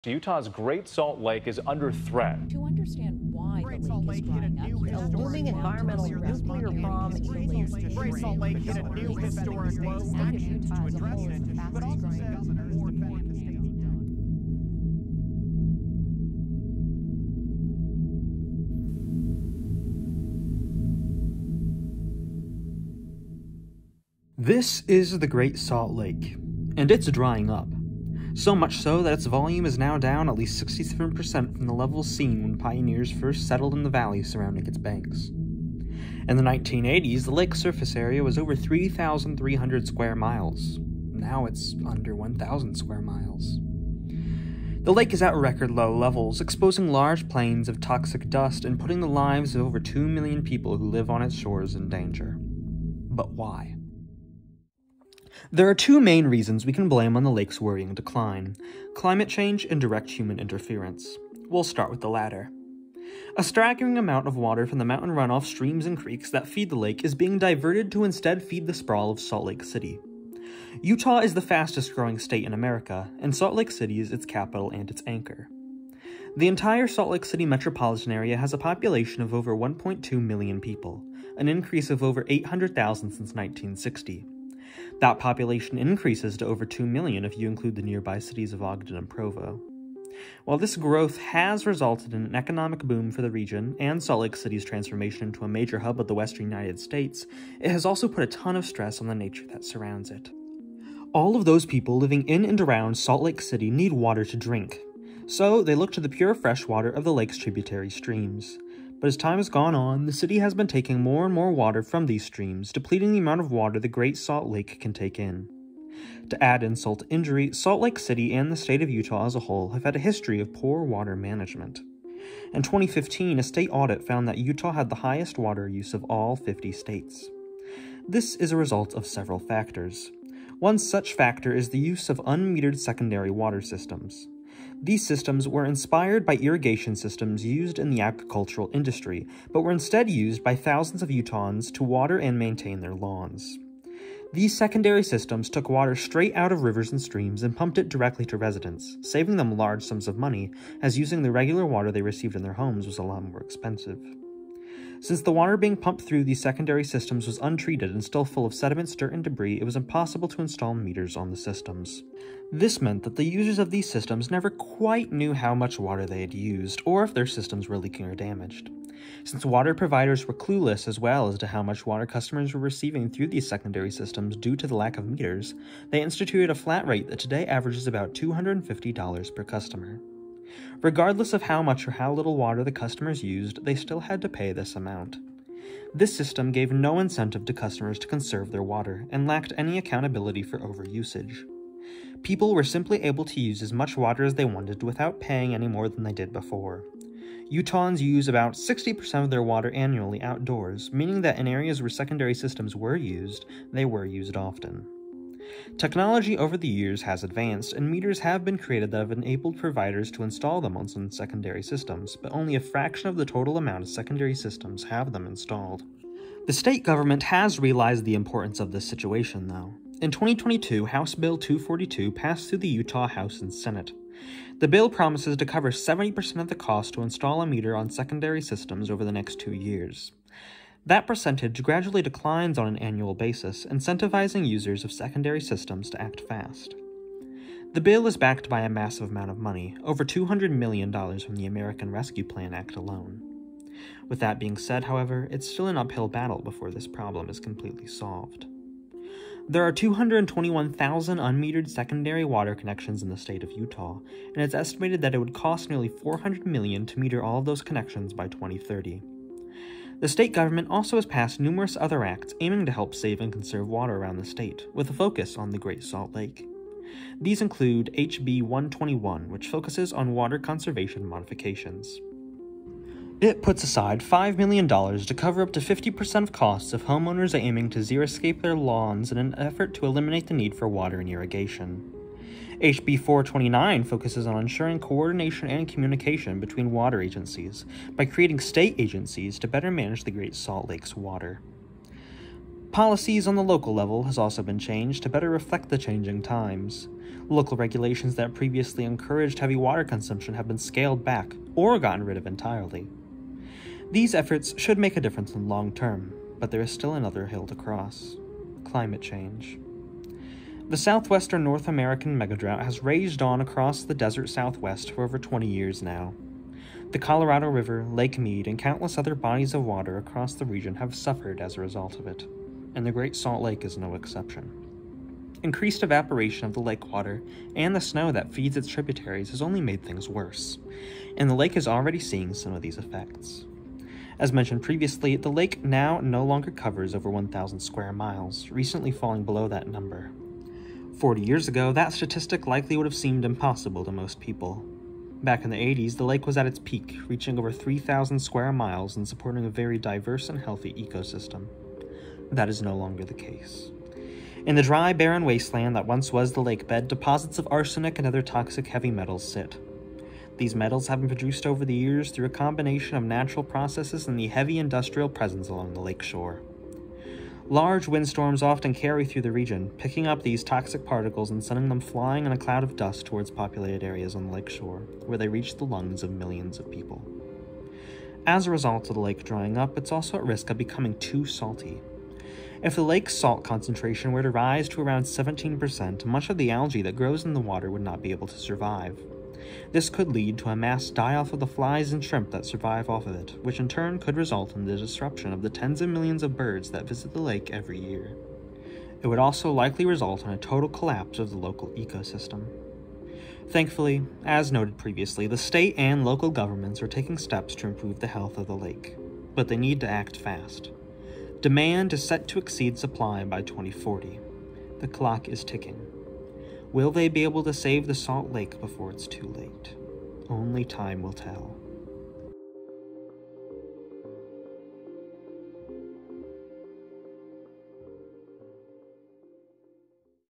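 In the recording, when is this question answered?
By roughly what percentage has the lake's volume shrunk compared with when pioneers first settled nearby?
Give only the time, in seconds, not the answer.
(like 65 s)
30 s.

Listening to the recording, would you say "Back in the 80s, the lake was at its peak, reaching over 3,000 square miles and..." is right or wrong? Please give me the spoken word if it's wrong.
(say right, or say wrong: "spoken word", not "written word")
right.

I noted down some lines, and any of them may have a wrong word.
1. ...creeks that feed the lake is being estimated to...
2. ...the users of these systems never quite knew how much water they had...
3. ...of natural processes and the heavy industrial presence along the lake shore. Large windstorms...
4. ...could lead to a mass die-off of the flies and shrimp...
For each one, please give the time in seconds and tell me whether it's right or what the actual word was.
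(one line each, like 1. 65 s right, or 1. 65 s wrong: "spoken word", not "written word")
1. 65 s wrong: "diverted", not "estimated"
2. 163 s right
3. 362 s right
4. 389 s right.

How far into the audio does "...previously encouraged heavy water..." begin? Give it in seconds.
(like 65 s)
298 s.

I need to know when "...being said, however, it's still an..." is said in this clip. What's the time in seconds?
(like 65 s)
244 s.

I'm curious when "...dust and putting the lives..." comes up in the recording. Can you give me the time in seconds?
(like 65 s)
48 s.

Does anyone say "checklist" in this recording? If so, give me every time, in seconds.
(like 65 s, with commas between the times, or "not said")
not said.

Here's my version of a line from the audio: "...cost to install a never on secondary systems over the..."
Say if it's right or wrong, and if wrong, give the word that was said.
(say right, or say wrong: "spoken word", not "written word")
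wrong: "meter", not "never".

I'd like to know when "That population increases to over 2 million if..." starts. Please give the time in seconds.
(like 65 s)
84 s.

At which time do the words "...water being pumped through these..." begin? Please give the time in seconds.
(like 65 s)
155 s.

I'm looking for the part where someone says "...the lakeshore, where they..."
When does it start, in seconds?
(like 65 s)
374 s.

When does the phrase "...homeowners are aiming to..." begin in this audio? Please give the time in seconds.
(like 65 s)
276 s.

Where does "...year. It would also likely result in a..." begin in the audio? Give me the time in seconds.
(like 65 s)
397 s.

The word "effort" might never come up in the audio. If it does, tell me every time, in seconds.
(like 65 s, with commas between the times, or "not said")
279 s, 304 s.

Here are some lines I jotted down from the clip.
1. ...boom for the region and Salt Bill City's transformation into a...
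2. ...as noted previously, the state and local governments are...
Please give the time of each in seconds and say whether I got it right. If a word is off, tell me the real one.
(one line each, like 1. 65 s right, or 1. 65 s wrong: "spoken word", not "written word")
1. 92 s wrong: "Lake", not "Bill"
2. 404 s right.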